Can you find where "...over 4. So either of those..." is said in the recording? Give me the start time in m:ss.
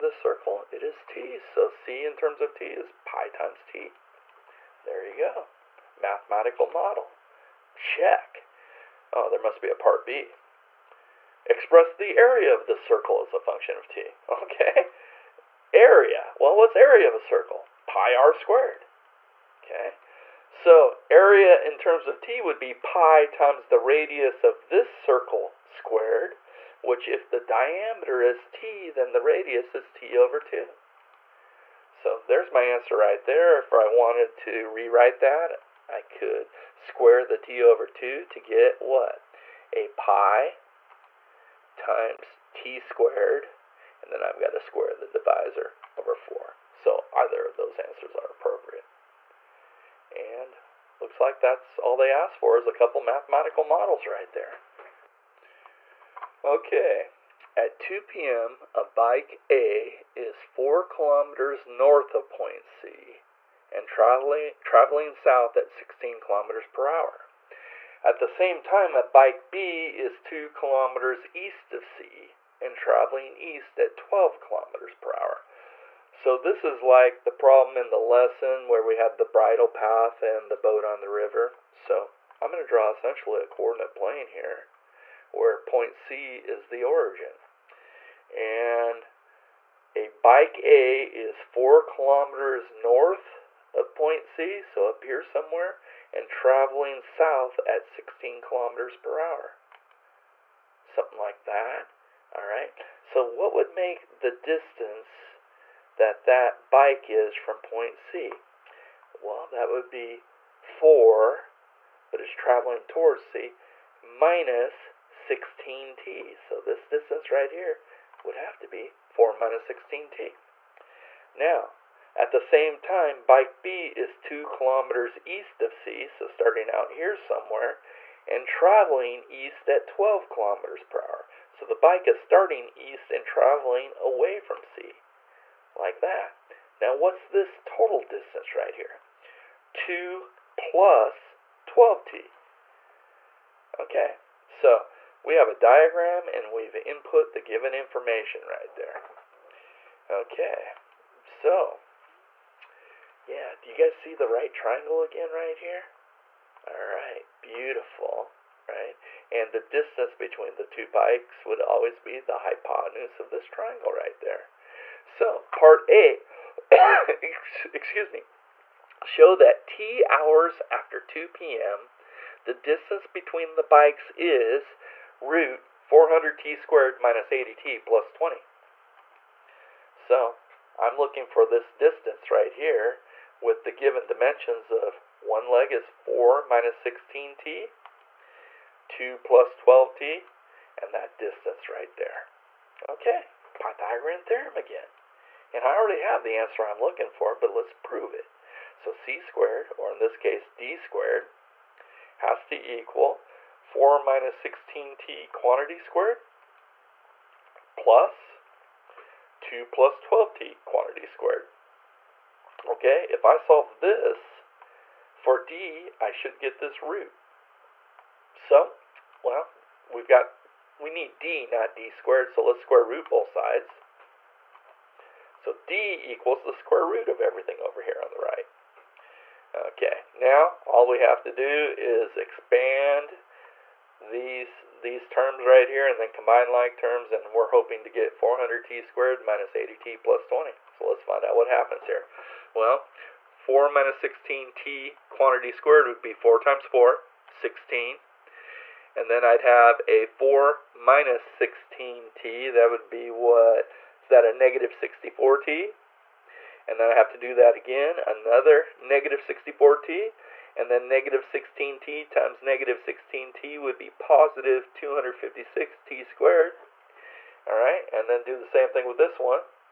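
0:45.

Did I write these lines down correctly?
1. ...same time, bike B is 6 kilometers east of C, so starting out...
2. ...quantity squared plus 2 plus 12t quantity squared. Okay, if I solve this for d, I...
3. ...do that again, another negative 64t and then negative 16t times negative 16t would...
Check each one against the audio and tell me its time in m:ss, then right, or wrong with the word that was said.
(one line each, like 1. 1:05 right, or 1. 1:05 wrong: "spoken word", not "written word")
1. 2:02 wrong: "2", not "6"
2. 3:25 right
3. 4:17 right.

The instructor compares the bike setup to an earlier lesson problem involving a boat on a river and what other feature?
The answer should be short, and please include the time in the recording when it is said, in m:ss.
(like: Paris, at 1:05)
bridle path, at 1:19.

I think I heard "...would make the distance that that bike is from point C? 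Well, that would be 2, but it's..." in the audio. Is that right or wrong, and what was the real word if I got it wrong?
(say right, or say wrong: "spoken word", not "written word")
wrong: "4", not "2".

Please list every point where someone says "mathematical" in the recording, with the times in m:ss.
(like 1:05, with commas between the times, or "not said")
0:05, 0:53.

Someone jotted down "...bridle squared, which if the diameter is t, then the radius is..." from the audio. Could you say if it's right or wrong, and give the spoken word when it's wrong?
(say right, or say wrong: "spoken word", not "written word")
wrong: "circle", not "bridle".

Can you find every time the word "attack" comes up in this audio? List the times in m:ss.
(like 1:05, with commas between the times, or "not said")
not said.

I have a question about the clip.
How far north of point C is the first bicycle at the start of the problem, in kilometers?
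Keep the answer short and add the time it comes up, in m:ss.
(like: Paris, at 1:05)
4, at 1:00.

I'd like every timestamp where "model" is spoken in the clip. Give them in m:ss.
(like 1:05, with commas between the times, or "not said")
0:06, 0:53.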